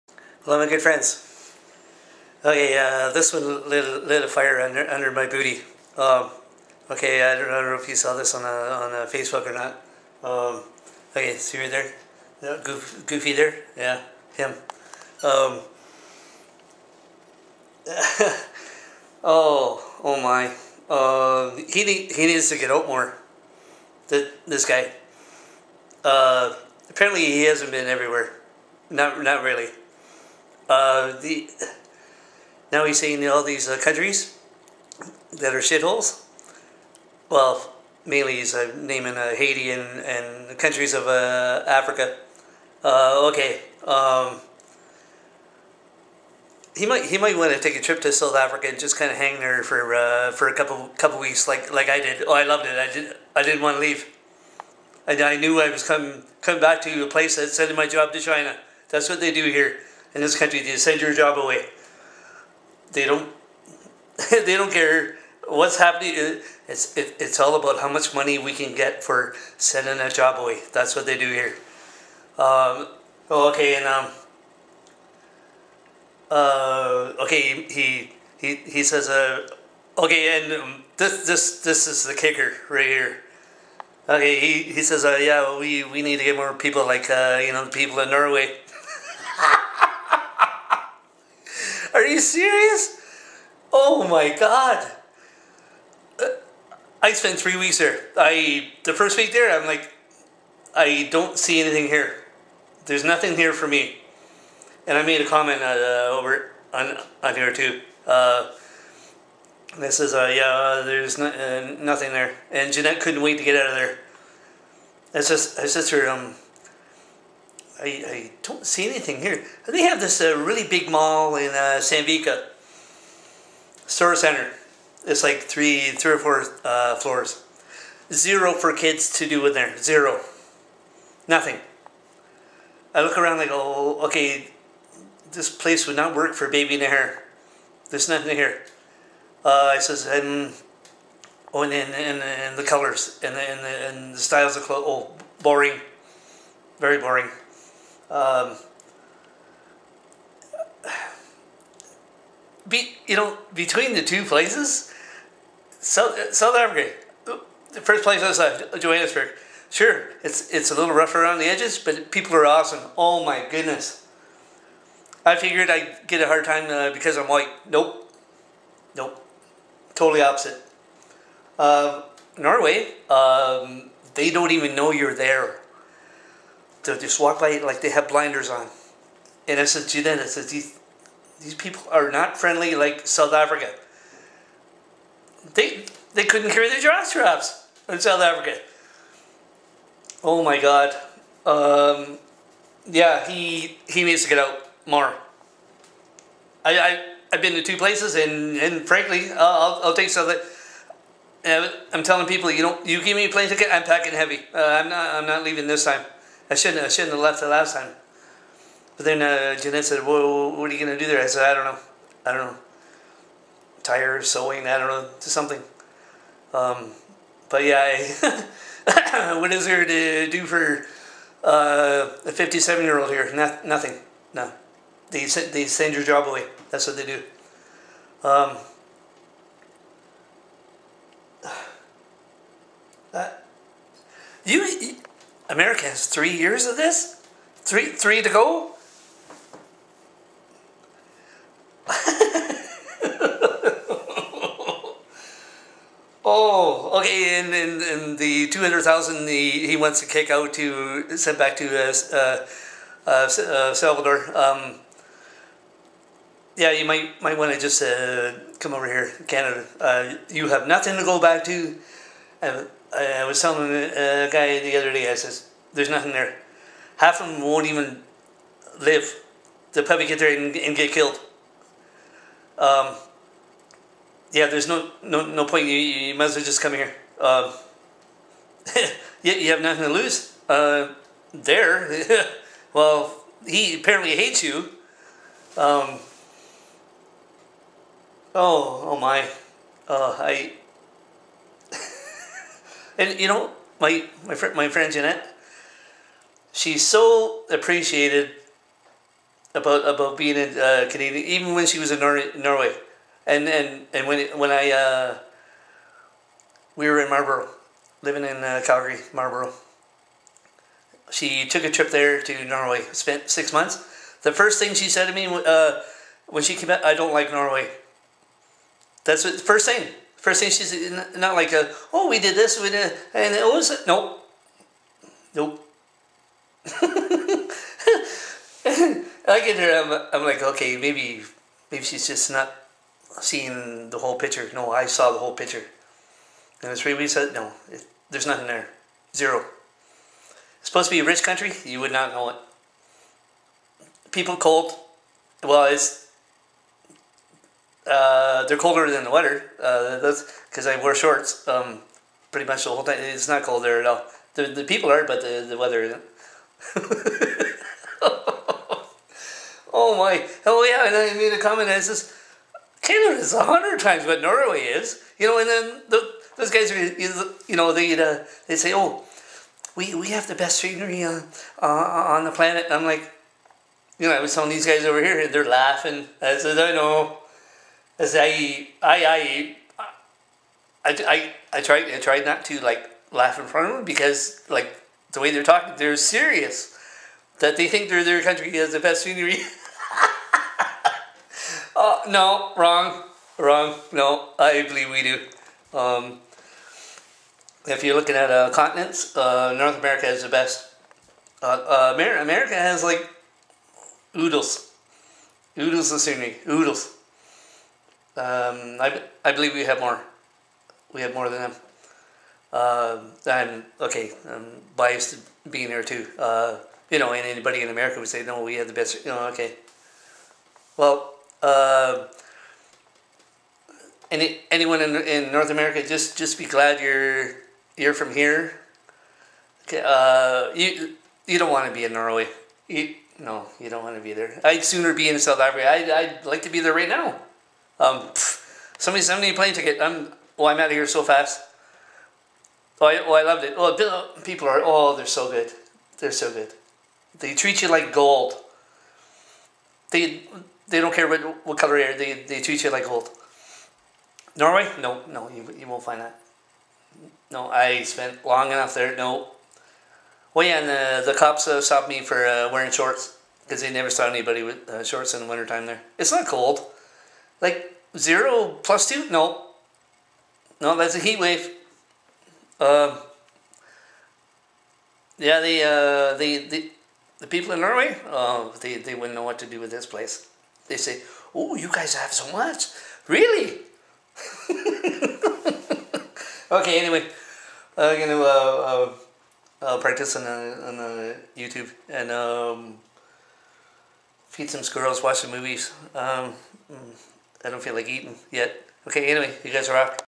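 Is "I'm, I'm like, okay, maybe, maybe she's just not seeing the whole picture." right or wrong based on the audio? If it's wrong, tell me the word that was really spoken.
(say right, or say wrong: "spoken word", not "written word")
right.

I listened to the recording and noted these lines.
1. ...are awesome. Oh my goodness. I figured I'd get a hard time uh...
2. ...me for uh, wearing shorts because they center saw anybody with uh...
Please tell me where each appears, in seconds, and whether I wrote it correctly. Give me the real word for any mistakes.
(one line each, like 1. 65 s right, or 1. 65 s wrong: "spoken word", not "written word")
1. 162 s right
2. 461 s wrong: "never", not "center".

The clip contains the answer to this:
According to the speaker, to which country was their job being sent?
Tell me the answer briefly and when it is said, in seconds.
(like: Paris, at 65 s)
China, at 58 s.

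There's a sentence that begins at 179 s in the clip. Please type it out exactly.
And I said to them, I said, these, these people are not friendly like South Africa.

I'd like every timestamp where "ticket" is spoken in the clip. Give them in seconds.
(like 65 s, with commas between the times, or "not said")
203 s, 439 s.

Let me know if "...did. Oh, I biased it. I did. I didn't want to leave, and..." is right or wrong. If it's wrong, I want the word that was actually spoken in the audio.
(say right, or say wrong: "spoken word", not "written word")
wrong: "loved", not "biased".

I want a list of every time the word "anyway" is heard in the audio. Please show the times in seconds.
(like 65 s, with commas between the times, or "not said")
486 s, 499 s.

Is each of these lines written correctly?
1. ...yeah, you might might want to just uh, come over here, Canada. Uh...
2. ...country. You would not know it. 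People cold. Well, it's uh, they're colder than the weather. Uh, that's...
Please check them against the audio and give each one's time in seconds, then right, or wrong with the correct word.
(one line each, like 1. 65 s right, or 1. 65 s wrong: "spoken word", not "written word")
1. 256 s right
2. 341 s right.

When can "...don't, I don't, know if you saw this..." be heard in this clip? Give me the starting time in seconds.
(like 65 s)
7 s.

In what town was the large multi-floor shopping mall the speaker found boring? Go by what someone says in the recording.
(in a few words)
Sandvika.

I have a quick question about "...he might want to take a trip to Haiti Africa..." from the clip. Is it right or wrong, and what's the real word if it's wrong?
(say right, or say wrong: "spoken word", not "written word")
wrong: "South", not "Haiti".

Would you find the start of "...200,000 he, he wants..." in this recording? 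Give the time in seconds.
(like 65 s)
248 s.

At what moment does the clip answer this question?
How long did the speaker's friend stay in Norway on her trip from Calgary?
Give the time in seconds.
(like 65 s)
313 s.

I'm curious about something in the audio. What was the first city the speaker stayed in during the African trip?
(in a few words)
Johannesburg.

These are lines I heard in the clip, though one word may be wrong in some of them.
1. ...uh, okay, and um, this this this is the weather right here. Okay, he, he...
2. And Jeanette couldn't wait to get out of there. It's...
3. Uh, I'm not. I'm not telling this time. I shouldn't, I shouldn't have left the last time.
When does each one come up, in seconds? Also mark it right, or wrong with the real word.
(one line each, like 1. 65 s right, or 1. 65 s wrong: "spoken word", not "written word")
1. 79 s wrong: "kicker", not "weather"
2. 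112 s right
3. 204 s wrong: "leaving", not "telling".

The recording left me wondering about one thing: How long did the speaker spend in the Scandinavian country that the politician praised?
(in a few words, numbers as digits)
3 weeks.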